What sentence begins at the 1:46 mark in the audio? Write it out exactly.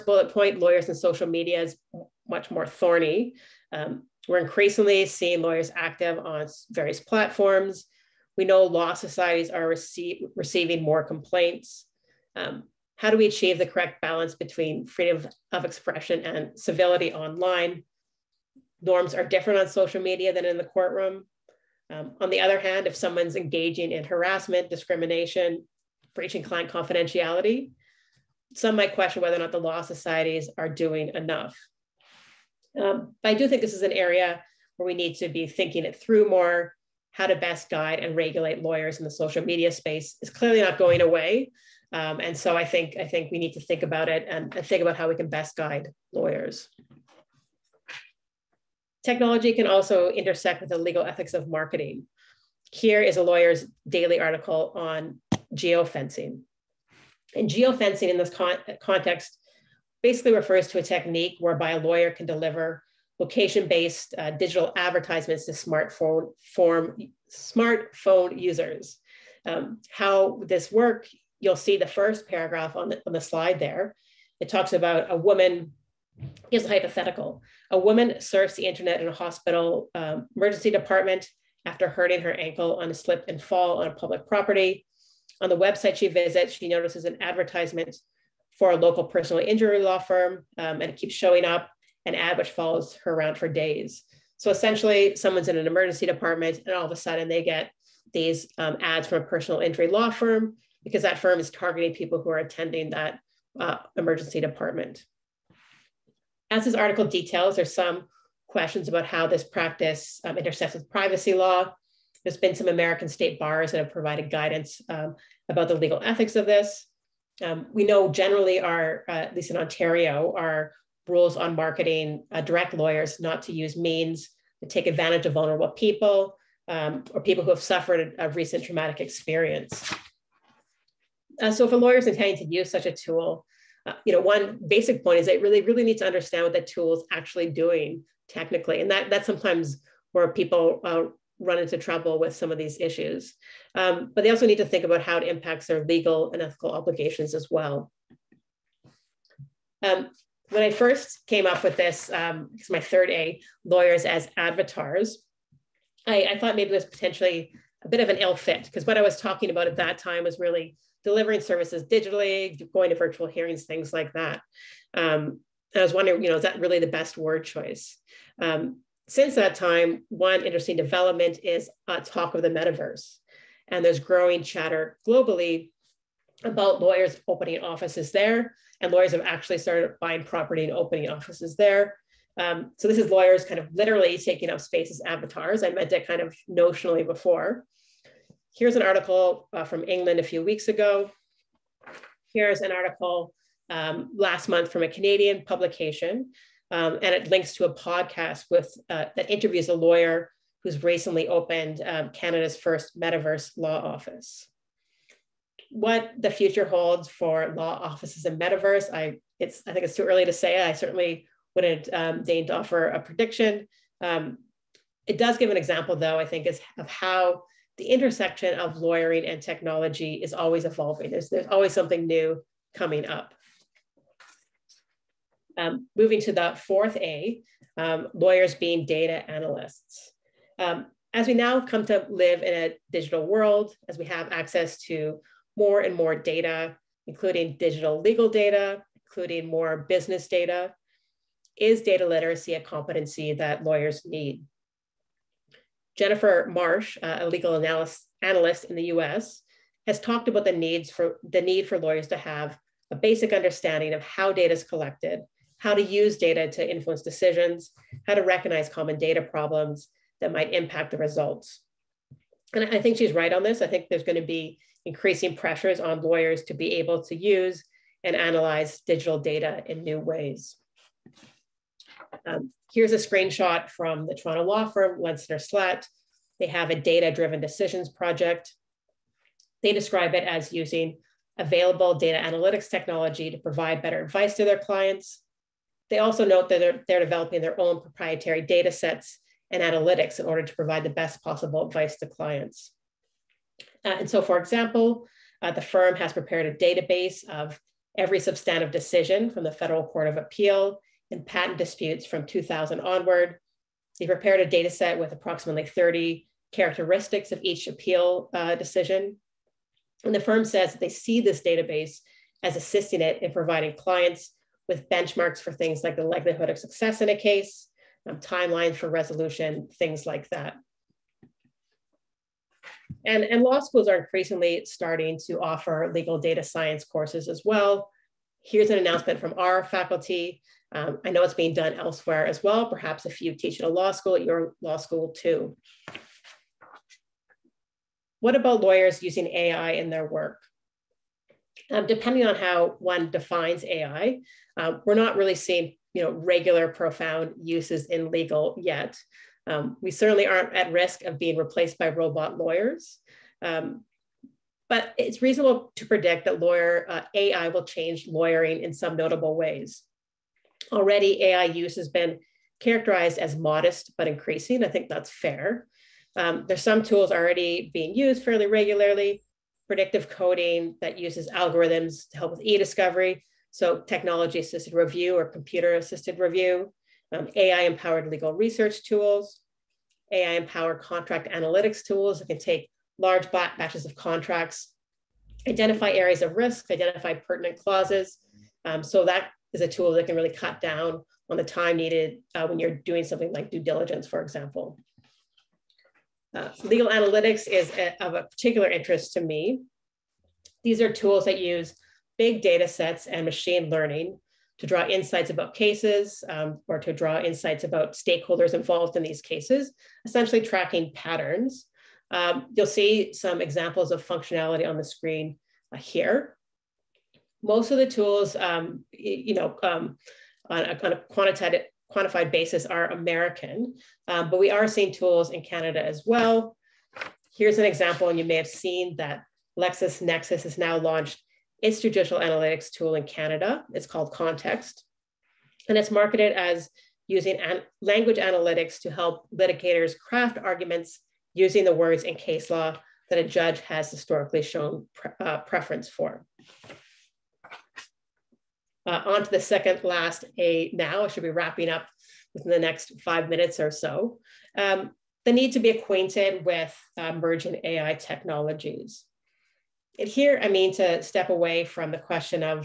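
As this article details, there's some questions about how this practice um, intersects with privacy law.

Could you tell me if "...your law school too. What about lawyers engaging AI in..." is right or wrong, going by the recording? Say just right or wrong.
wrong.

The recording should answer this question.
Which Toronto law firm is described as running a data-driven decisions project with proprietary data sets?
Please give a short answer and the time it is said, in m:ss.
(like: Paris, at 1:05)
Lenczner Slaght, at 4:34.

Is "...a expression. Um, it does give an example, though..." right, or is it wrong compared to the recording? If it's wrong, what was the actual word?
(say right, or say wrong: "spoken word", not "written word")
wrong: "prediction", not "expression".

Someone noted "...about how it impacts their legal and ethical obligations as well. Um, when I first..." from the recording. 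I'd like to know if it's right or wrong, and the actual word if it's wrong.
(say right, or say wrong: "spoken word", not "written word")
right.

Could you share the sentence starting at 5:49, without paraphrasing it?
Um, we certainly aren't at risk of being replaced by robot lawyers.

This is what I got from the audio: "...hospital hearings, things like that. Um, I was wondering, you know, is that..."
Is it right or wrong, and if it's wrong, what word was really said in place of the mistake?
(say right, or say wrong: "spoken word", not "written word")
wrong: "virtual", not "hospital".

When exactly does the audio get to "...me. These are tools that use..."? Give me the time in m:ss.
6:39.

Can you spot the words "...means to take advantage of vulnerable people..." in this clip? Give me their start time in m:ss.
2:03.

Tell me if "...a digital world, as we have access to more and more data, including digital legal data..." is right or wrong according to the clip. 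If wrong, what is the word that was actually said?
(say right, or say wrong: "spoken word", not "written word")
right.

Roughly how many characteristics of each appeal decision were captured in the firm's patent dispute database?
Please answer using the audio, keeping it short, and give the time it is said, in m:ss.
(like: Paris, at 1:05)
30, at 5:05.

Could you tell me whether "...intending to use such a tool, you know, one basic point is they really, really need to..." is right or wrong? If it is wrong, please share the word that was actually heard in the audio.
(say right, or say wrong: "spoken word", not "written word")
right.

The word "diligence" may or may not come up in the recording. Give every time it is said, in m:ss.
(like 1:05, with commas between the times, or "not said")
6:33.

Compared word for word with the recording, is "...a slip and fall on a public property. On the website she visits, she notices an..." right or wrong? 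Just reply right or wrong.
right.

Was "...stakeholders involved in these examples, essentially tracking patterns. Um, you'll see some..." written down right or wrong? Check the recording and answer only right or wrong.
wrong.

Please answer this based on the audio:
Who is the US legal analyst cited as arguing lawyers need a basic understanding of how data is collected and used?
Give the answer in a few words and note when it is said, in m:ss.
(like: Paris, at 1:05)
Jennifer Marsh, at 4:05.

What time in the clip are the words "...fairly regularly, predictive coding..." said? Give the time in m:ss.
6:08.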